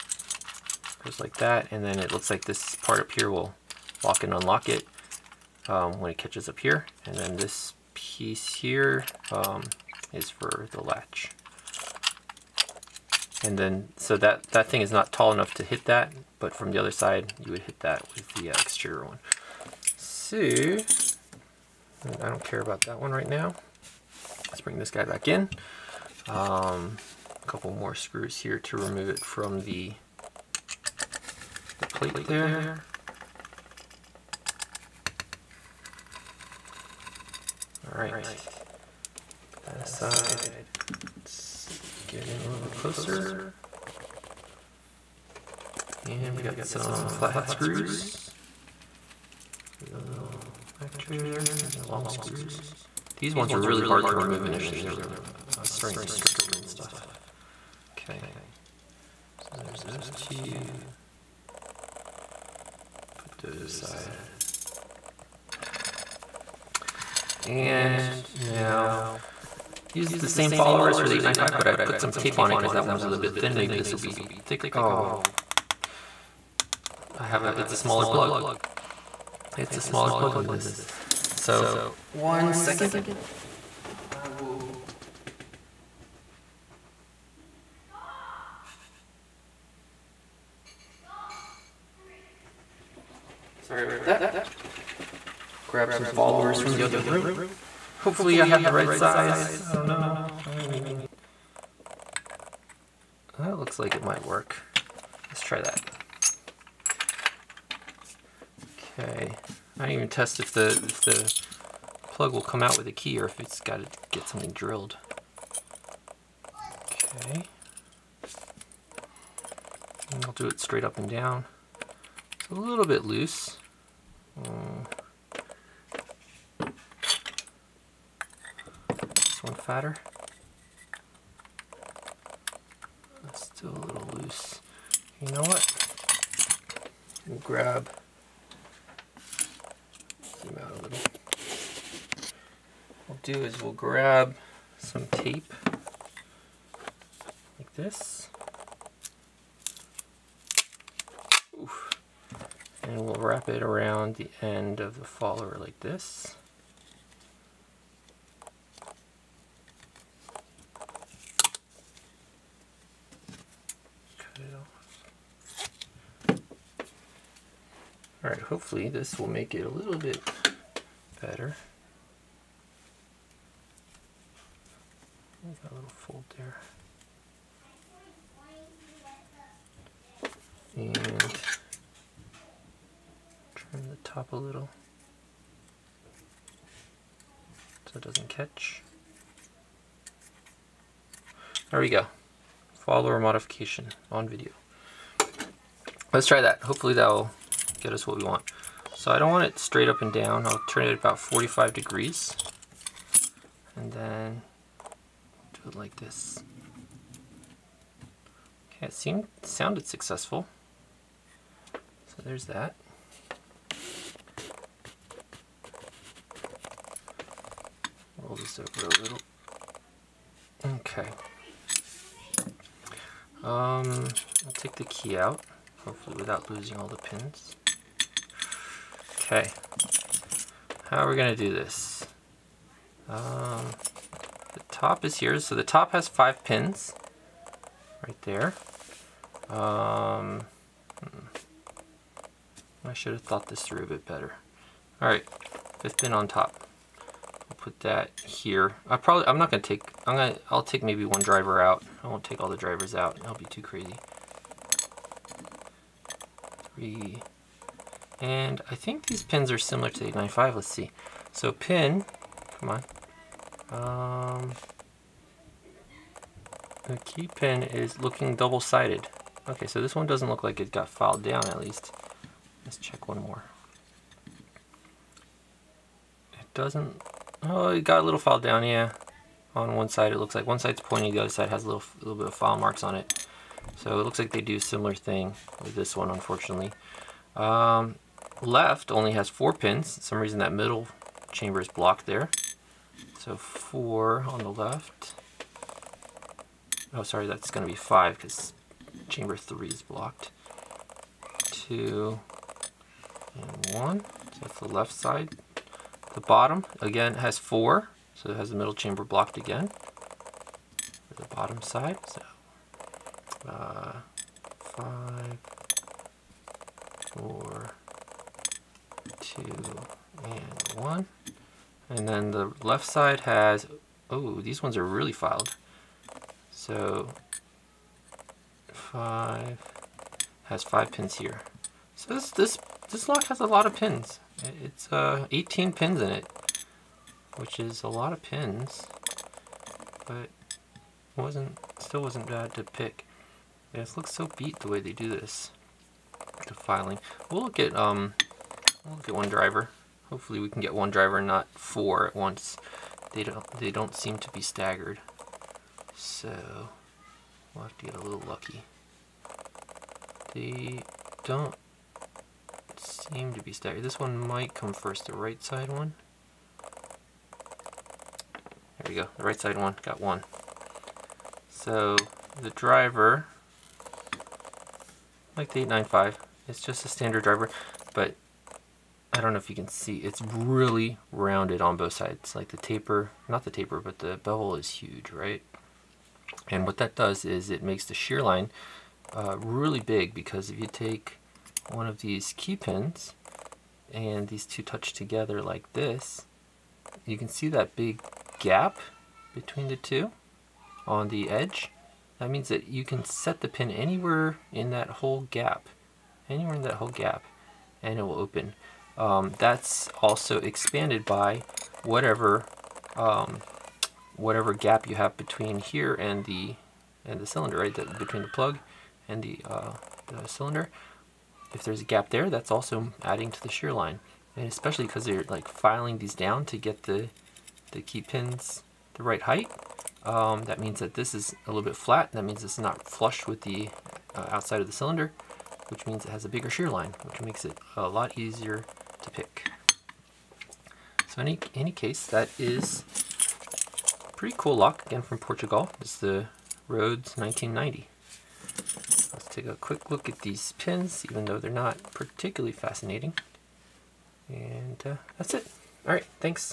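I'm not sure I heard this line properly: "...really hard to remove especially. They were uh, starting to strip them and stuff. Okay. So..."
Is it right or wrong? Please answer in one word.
wrong.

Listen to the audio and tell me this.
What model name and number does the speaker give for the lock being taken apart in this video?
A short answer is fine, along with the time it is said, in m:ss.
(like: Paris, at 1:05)
Rodes 1990, at 7:26.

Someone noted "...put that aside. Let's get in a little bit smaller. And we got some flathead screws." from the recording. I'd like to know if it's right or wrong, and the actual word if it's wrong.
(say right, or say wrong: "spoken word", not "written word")
wrong: "closer", not "smaller".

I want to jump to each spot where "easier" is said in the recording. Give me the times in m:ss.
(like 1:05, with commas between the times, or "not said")
7:18.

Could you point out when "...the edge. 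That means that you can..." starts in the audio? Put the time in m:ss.
6:41.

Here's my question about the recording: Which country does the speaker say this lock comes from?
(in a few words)
Portugal.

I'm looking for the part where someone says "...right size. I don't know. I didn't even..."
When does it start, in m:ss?
1:38.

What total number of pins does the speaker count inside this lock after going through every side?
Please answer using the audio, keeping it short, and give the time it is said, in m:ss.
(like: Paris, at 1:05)
18, at 5:35.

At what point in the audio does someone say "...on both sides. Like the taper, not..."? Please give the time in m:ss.
6:21.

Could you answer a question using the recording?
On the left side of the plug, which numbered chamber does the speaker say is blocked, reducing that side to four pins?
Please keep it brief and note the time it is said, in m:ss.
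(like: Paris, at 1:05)
3, at 4:59.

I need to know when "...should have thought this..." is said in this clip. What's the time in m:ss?
4:02.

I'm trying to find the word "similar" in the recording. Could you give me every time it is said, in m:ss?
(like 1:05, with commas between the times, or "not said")
4:19, 4:44.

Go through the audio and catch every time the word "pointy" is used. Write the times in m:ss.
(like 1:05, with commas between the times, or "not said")
4:40.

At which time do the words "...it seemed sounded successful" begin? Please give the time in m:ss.
3:28.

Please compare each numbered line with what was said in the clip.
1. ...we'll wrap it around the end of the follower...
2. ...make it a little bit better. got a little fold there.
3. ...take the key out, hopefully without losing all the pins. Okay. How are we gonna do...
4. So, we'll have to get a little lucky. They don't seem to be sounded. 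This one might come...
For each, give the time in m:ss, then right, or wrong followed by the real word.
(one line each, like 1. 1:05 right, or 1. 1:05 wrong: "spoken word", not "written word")
1. 2:33 right
2. 2:49 right
3. 3:44 right
4. 5:55 wrong: "staggered", not "sounded".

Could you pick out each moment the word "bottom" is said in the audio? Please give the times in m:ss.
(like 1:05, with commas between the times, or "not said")
5:06, 5:11.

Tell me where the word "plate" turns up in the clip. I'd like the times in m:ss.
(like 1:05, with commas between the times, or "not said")
0:31.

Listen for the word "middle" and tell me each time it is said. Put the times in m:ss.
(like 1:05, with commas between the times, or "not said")
4:50, 5:08.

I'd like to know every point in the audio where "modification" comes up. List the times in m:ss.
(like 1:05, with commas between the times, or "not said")
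3:13.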